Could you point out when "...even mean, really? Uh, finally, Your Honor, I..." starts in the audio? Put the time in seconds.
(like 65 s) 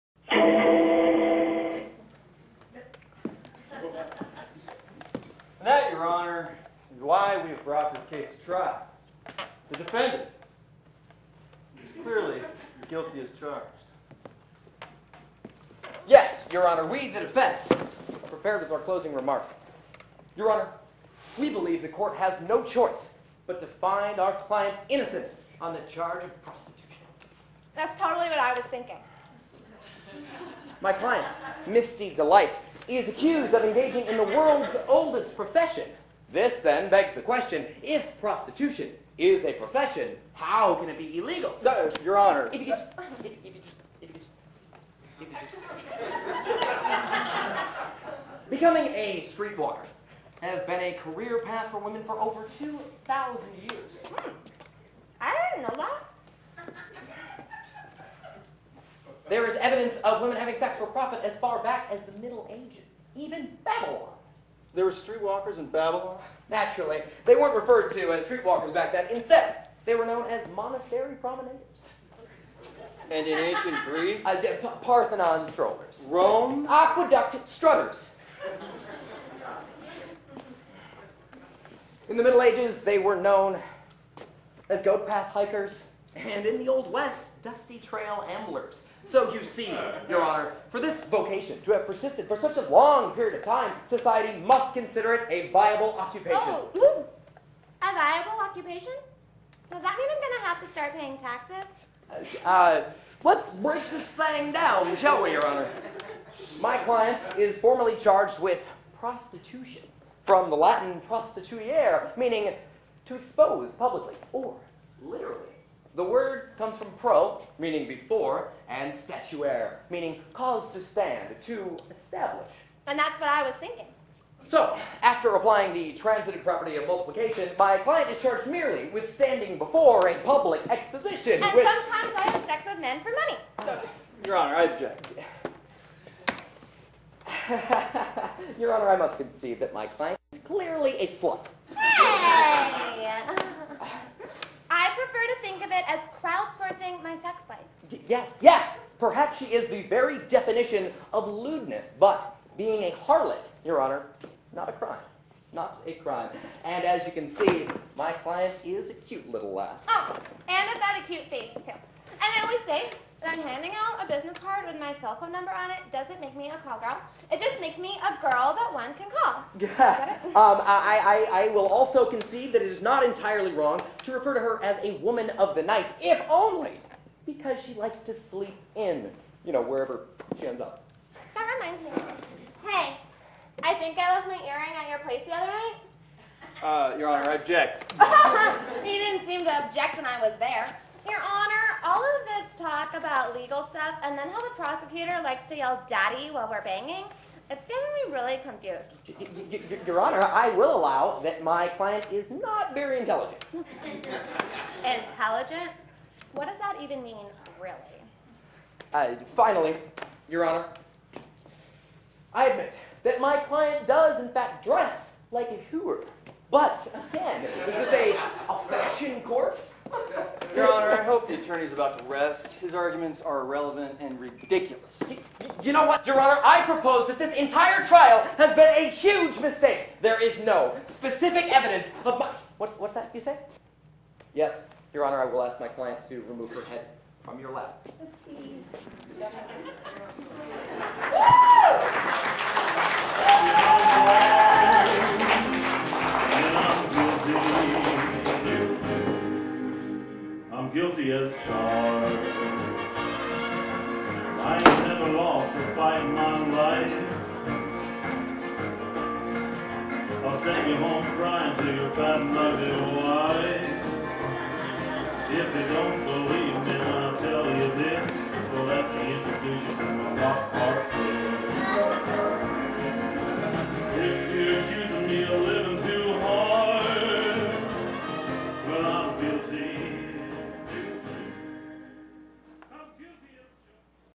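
206 s.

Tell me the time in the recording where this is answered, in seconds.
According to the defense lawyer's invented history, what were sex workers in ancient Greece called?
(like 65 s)
74 s.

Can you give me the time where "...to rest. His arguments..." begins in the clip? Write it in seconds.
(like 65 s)
221 s.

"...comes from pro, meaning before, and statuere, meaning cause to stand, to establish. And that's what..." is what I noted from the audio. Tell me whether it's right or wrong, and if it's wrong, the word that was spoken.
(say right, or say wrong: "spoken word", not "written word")
right.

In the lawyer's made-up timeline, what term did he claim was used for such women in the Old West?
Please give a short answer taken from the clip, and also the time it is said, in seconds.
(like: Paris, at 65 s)
dusty trail amblers, at 87 s.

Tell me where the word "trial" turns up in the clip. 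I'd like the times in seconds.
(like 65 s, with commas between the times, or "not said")
8 s, 227 s.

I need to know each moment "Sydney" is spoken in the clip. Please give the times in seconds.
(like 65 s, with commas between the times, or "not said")
not said.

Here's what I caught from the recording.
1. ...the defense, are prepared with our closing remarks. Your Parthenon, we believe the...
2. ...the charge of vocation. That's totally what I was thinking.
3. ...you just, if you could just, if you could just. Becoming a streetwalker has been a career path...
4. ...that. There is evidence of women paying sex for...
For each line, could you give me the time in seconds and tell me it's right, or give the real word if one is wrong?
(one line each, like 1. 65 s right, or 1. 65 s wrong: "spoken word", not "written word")
1. 17 s wrong: "Honor", not "Parthenon"
2. 25 s wrong: "prostitution", not "vocation"
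3. 43 s right
4. 55 s wrong: "having", not "paying".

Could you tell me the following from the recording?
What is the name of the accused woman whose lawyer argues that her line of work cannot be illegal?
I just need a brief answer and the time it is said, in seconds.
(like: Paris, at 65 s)
Misty Delight, at 31 s.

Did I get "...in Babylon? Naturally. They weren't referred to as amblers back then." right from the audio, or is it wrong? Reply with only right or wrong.
wrong.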